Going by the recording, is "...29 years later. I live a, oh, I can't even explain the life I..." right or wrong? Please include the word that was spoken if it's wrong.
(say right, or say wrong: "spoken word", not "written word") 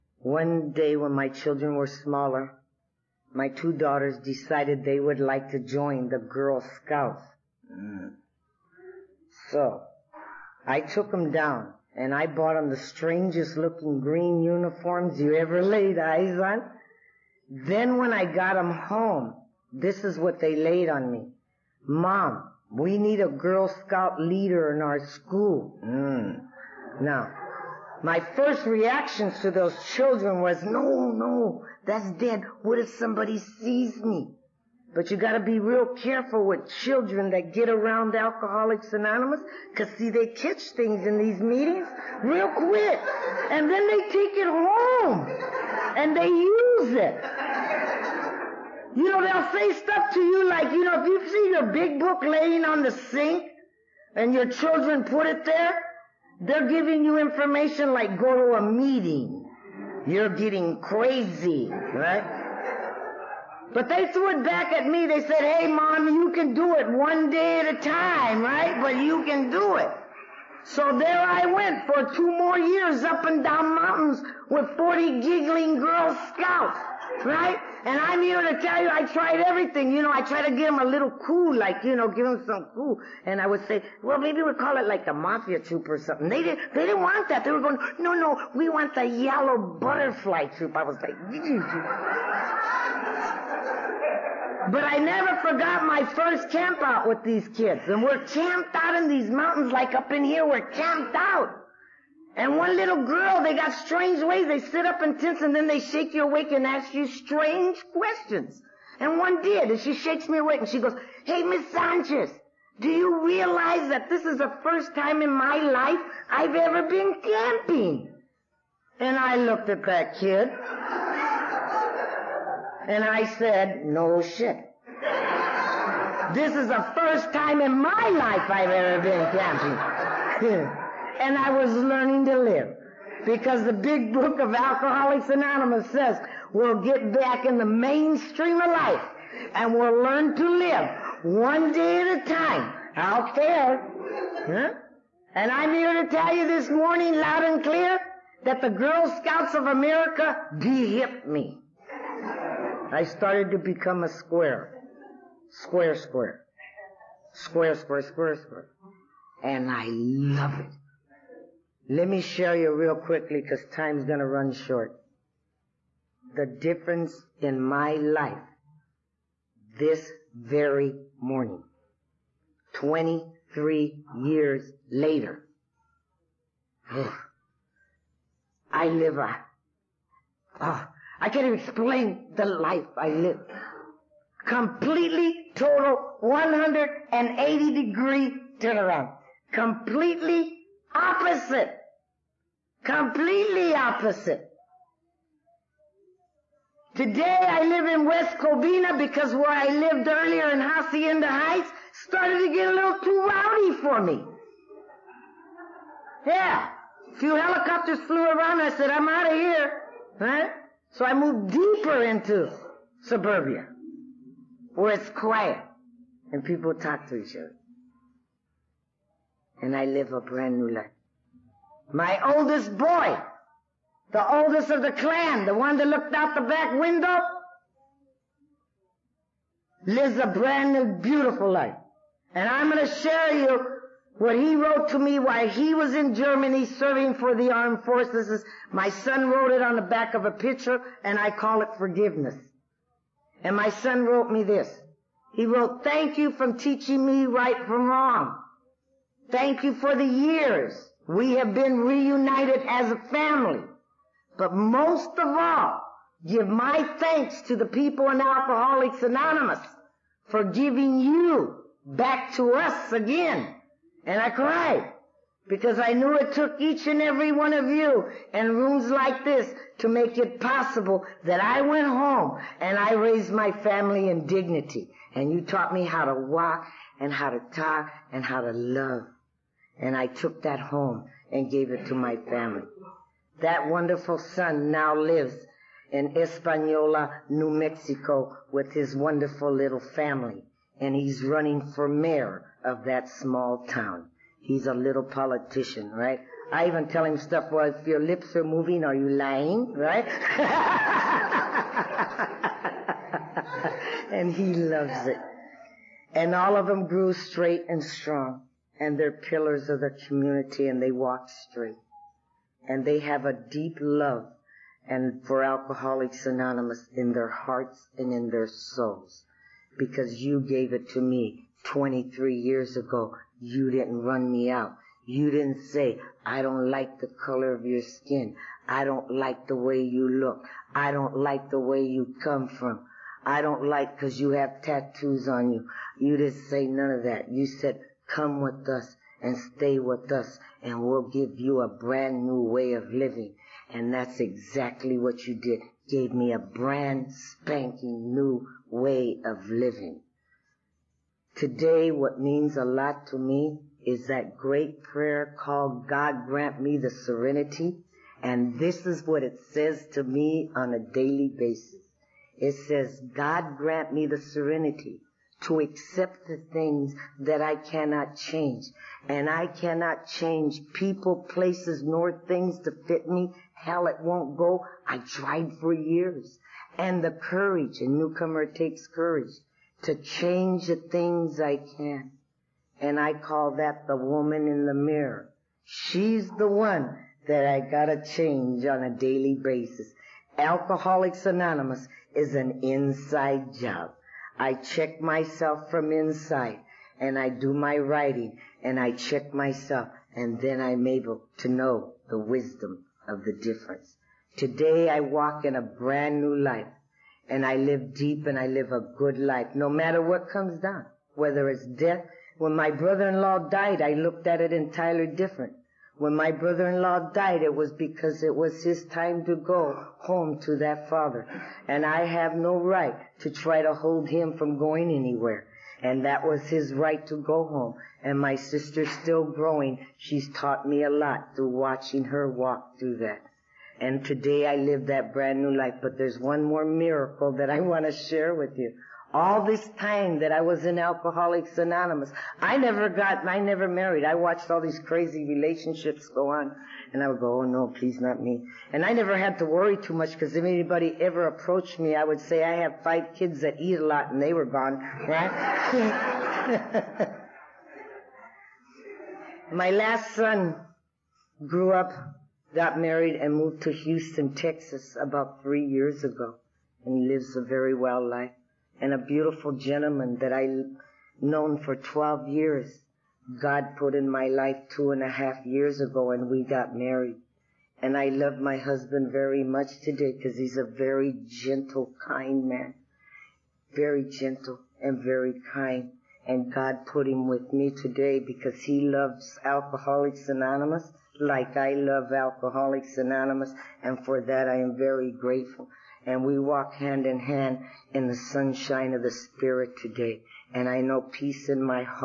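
wrong: "23", not "29".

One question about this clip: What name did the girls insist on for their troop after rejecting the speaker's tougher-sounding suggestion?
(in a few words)
Yellow Butterfly Troop.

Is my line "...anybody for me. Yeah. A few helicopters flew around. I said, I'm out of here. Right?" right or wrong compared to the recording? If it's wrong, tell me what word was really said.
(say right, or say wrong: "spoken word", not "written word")
wrong: "rowdy", not "anybody".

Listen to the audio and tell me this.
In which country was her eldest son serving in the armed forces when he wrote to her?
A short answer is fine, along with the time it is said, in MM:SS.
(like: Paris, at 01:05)
Germany, at 03:56.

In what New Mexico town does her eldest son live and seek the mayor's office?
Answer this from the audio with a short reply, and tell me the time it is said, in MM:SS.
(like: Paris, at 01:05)
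Espanola, at 04:46.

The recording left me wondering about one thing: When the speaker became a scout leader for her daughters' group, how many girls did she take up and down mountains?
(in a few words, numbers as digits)
40.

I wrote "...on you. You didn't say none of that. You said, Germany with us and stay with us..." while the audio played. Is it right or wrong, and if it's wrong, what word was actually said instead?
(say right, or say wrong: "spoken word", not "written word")
wrong: "Come", not "Germany".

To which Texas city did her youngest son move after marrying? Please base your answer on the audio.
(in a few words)
Houston.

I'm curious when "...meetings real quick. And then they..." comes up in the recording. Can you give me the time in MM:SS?
00:41.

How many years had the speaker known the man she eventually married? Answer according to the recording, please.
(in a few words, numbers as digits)
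12.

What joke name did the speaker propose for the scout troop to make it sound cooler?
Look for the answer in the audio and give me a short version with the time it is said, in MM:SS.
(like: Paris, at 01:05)
Mafia Troop, at 01:25.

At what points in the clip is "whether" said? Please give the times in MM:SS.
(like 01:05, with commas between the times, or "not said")
06:51.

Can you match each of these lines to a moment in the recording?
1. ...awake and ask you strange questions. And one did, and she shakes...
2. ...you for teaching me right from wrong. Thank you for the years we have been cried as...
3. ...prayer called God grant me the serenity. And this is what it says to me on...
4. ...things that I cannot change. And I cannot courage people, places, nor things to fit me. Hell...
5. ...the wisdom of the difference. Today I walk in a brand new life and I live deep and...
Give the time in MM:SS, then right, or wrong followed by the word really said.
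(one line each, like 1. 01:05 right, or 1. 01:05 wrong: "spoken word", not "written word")
1. 01:46 right
2. 04:06 wrong: "reunited", not "cried"
3. 05:54 right
4. 06:06 wrong: "change", not "courage"
5. 06:42 right.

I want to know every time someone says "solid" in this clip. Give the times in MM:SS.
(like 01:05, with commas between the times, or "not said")
not said.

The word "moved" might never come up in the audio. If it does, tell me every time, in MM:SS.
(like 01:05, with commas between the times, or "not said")
03:31, 07:43.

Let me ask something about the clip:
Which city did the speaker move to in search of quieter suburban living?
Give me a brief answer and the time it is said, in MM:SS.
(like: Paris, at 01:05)
West Covina, at 03:18.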